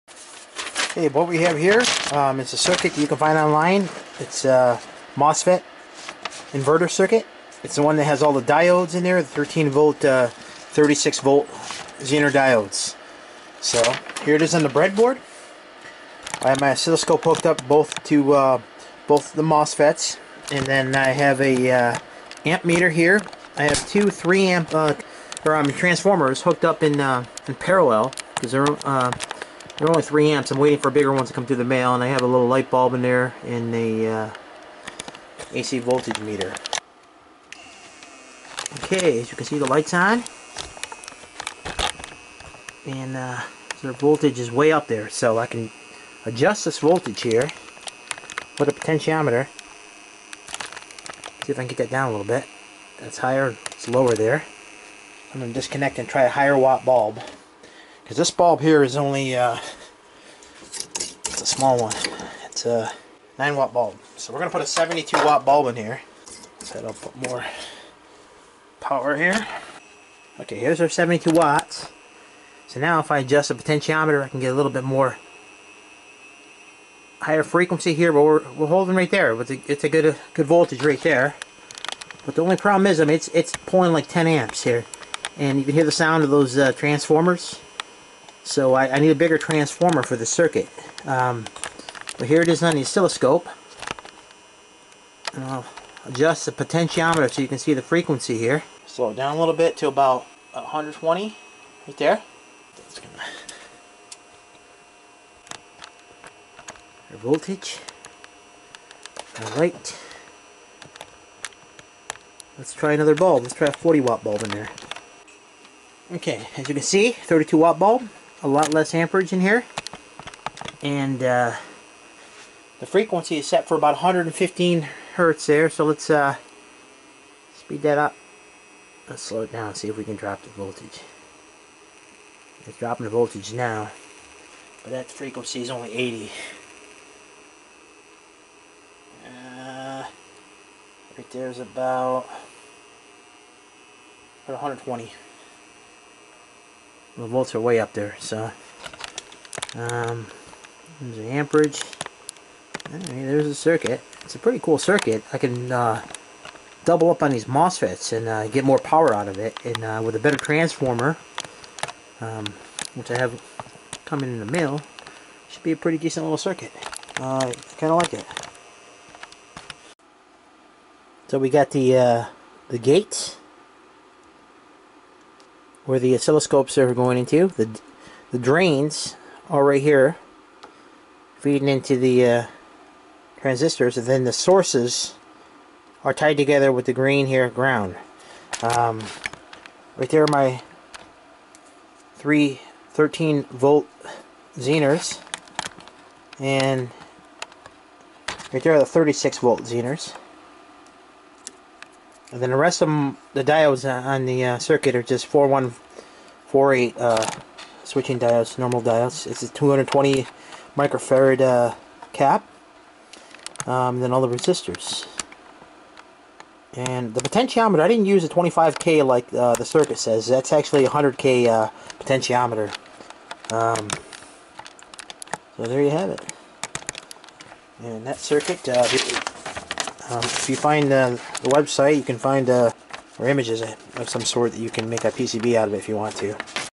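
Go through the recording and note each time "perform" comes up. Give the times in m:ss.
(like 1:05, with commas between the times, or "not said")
not said.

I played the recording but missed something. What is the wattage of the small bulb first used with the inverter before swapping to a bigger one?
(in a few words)
9 watts.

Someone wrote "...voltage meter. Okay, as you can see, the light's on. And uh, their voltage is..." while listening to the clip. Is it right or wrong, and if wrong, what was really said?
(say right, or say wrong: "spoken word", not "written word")
right.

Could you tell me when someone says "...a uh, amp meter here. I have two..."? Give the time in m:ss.
0:21.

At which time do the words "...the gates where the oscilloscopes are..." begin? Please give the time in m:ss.
2:52.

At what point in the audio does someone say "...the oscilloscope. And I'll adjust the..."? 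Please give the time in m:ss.
1:32.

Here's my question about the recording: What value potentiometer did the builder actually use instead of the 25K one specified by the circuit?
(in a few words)
100K.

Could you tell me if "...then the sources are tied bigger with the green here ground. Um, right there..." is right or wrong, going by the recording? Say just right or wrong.
wrong.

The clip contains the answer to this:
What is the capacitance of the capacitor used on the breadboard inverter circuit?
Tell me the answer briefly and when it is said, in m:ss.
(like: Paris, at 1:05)
220 microfarad, at 3:29.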